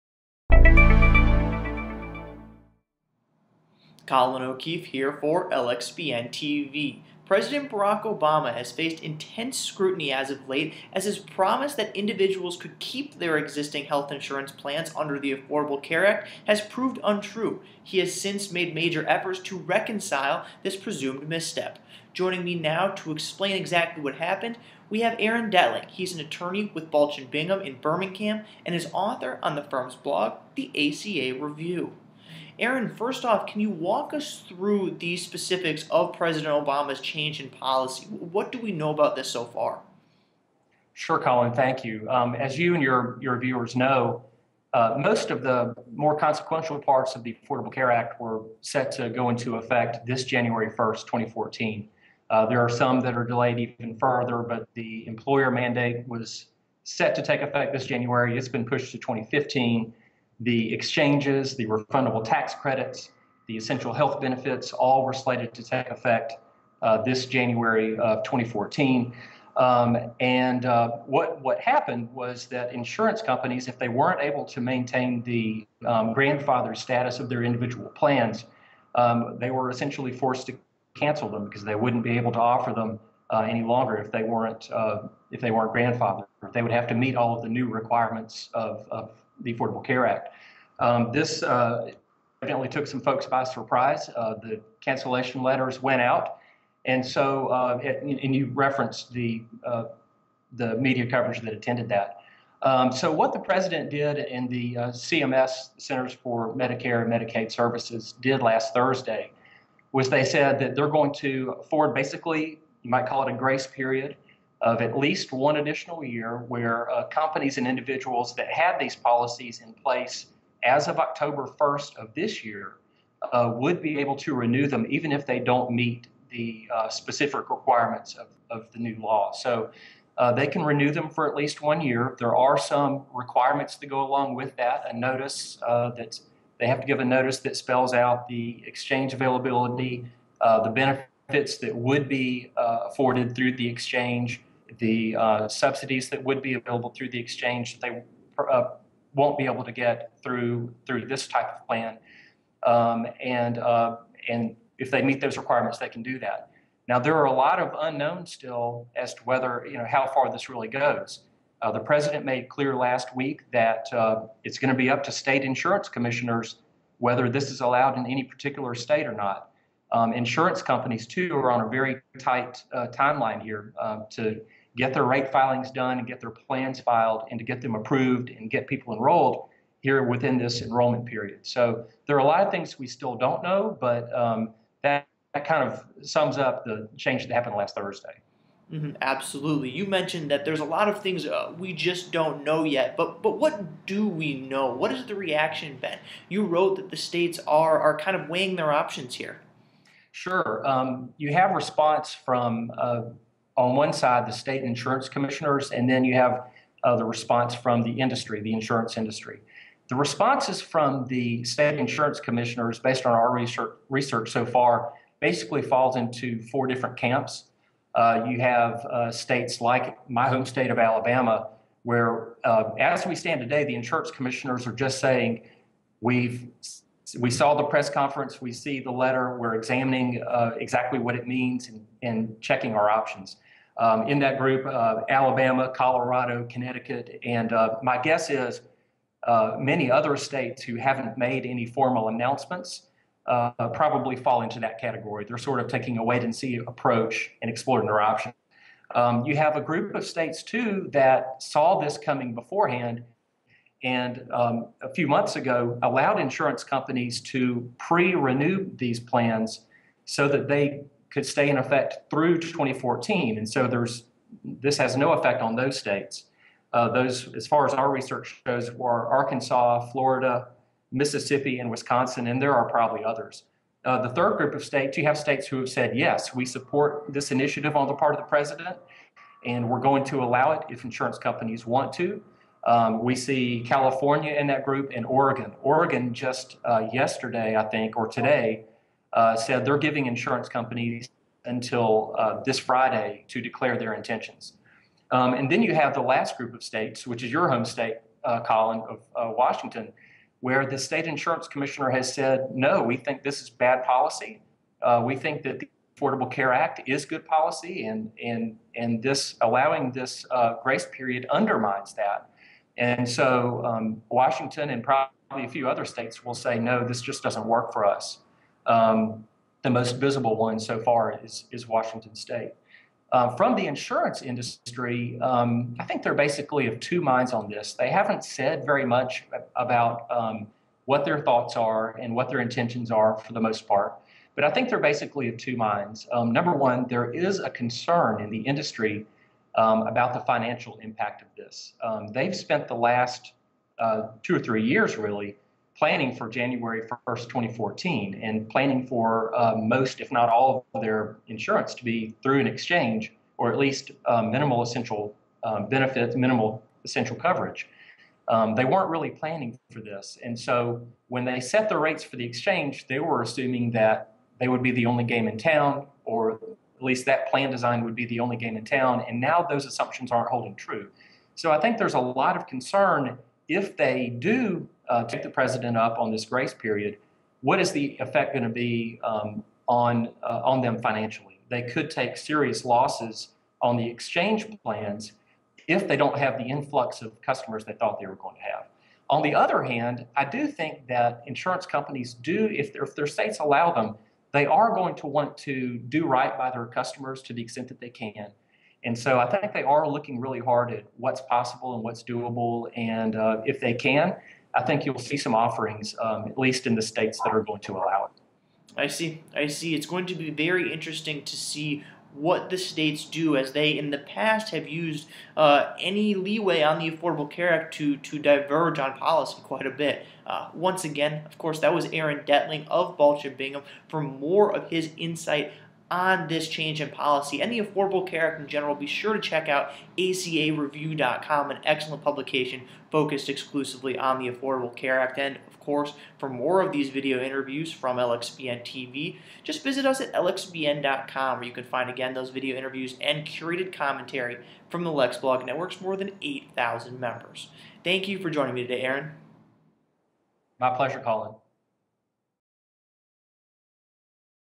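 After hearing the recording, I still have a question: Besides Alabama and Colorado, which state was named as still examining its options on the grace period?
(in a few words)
Connecticut.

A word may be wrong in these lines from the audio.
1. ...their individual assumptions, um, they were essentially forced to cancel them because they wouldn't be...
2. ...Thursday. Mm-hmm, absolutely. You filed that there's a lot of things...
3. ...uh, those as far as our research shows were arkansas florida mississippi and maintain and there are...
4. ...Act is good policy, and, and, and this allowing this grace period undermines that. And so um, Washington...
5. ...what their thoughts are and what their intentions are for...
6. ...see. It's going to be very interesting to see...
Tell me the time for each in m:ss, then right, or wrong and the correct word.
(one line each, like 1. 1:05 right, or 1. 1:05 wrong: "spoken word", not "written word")
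1. 1:17 wrong: "plans", not "assumptions"
2. 3:07 wrong: "mentioned", not "filed"
3. 4:26 wrong: "wisconsin", not "maintain"
4. 5:06 right
5. 5:30 right
6. 6:49 right.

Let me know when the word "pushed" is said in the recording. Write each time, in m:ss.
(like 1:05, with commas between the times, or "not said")
0:58.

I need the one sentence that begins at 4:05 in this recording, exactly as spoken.
They're sort of taking a wait and see approach and exploring their options.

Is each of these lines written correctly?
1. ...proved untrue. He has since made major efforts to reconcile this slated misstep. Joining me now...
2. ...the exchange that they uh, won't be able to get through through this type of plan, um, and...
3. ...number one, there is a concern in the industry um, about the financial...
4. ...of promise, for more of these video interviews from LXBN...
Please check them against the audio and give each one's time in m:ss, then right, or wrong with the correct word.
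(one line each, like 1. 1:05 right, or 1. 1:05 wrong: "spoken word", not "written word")
1. 0:16 wrong: "presumed", not "slated"
2. 2:27 right
3. 5:36 right
4. 7:15 wrong: "course", not "promise".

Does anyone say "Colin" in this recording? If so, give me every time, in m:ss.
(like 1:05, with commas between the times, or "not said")
0:04, 0:41, 4:58, 7:31.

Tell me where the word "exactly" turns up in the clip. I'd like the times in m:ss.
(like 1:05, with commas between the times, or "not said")
0:23, 3:50.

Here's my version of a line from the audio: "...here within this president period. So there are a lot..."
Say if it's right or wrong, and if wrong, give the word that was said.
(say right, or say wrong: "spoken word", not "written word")
wrong: "enrollment", not "president".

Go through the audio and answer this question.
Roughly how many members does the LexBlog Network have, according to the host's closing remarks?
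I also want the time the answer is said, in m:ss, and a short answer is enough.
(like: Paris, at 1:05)
8,000, at 7:25.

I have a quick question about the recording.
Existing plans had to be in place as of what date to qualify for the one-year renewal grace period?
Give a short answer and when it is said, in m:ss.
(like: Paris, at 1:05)
October 1st, at 2:00.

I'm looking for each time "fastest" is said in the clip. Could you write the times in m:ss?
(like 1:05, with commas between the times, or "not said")
not said.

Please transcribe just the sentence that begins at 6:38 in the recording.
And so I think they are looking really hard at what's possible and what's doable.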